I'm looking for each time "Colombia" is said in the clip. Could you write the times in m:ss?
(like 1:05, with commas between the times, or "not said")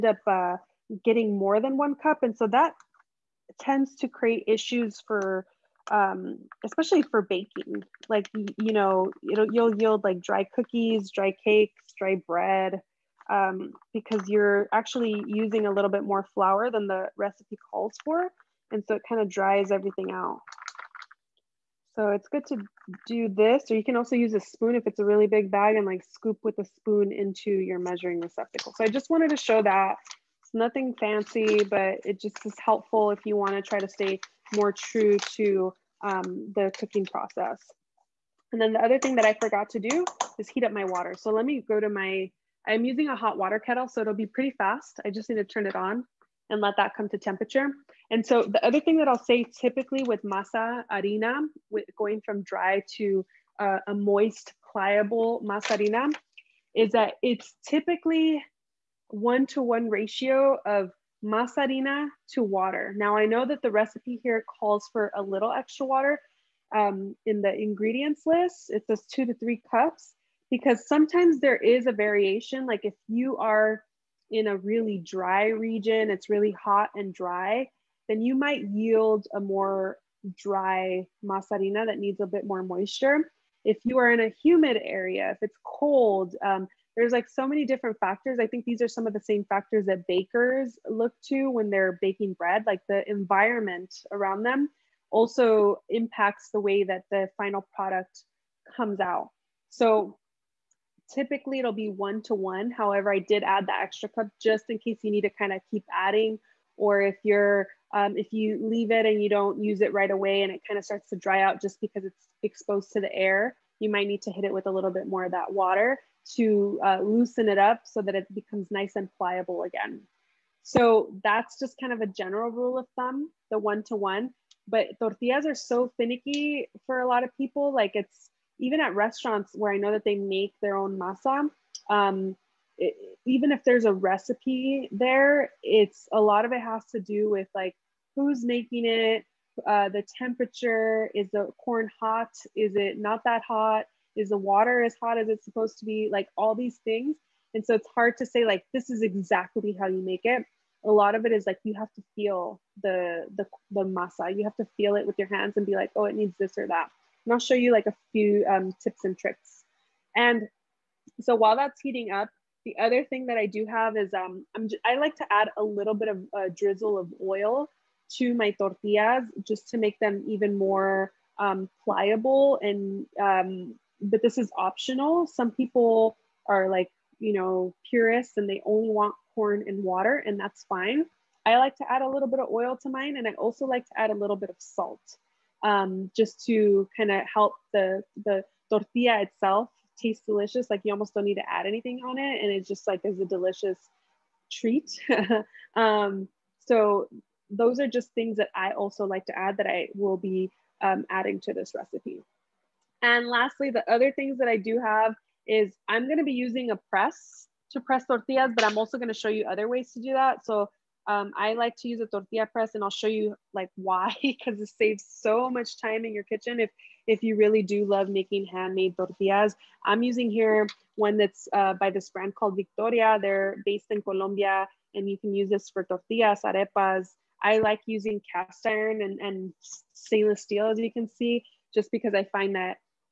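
3:44.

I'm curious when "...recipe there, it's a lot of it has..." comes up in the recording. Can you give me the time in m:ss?
2:13.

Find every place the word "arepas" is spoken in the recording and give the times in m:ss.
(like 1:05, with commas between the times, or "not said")
3:46.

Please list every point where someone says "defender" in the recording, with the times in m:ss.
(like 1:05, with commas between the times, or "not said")
not said.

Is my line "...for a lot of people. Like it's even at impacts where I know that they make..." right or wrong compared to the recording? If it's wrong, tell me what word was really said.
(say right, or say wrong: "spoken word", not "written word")
wrong: "restaurants", not "impacts".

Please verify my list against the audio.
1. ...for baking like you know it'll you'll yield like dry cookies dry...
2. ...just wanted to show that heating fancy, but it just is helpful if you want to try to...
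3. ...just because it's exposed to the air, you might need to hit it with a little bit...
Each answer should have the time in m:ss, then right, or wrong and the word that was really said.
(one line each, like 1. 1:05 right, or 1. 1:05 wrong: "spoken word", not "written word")
1. 0:07 right
2. 0:28 wrong: "nothing", not "heating"
3. 1:51 right.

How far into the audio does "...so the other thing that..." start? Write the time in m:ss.
0:48.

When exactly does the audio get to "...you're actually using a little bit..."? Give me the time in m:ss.
0:14.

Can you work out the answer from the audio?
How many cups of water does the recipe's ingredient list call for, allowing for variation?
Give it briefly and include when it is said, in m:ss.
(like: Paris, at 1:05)
2 to 3 cups, at 1:09.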